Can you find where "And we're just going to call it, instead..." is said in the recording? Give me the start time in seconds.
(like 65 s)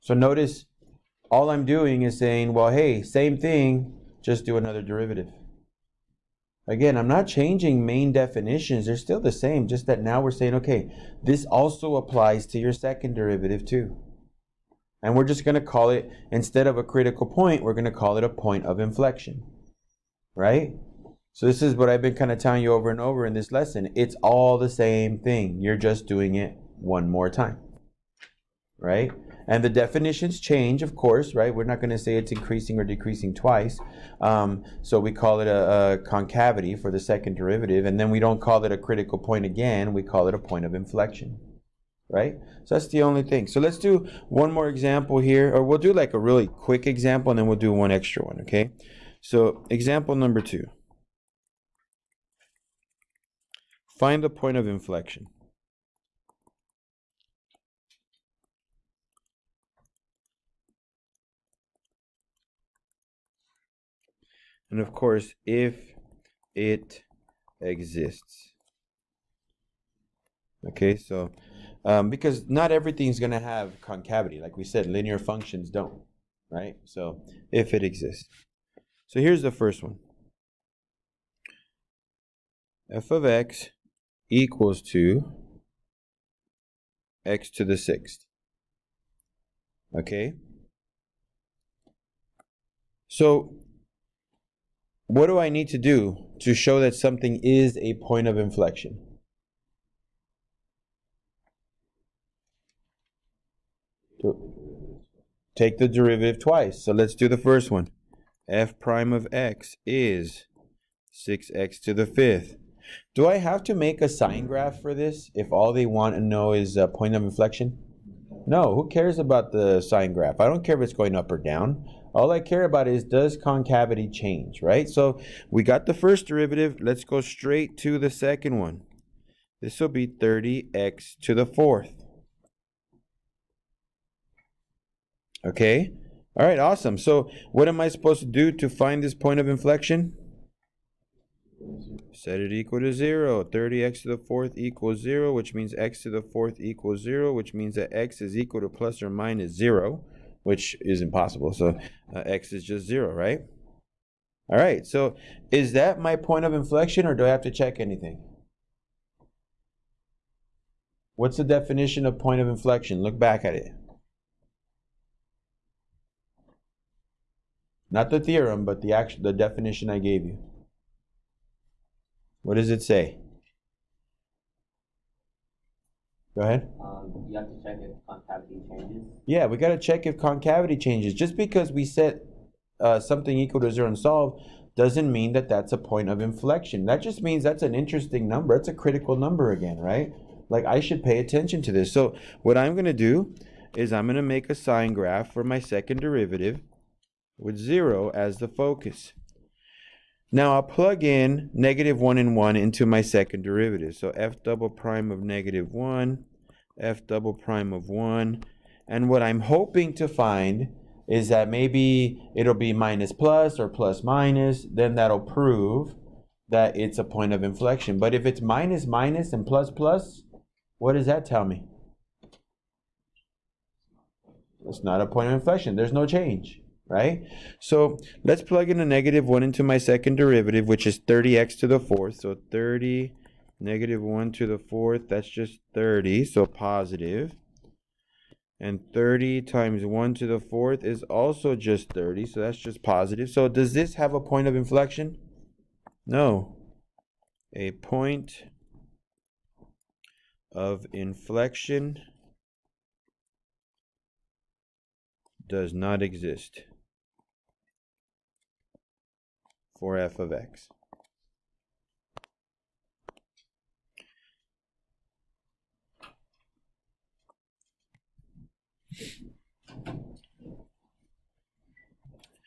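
15 s.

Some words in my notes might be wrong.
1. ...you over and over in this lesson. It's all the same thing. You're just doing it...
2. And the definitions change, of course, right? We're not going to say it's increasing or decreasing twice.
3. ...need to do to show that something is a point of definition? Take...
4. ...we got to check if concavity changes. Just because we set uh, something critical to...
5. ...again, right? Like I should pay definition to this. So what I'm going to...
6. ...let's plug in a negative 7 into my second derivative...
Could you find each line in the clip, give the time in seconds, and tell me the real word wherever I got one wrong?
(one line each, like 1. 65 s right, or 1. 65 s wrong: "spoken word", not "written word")
1. 22 s right
2. 29 s right
3. 95 s wrong: "inflection", not "definition"
4. 179 s wrong: "equal", not "critical"
5. 189 s wrong: "attention", not "definition"
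6. 228 s wrong: "1", not "7".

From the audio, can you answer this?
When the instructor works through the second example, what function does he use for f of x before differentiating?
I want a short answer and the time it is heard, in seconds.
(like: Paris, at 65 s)
x to the sixth, at 87 s.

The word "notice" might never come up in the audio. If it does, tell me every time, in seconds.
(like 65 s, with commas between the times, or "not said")
0 s.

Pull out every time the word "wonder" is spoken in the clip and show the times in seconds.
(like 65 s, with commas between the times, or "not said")
not said.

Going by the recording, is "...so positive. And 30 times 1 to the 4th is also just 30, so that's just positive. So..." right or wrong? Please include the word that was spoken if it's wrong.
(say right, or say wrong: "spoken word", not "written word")
right.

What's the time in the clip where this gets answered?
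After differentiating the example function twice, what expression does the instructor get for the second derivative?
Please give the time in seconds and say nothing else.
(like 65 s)
130 s.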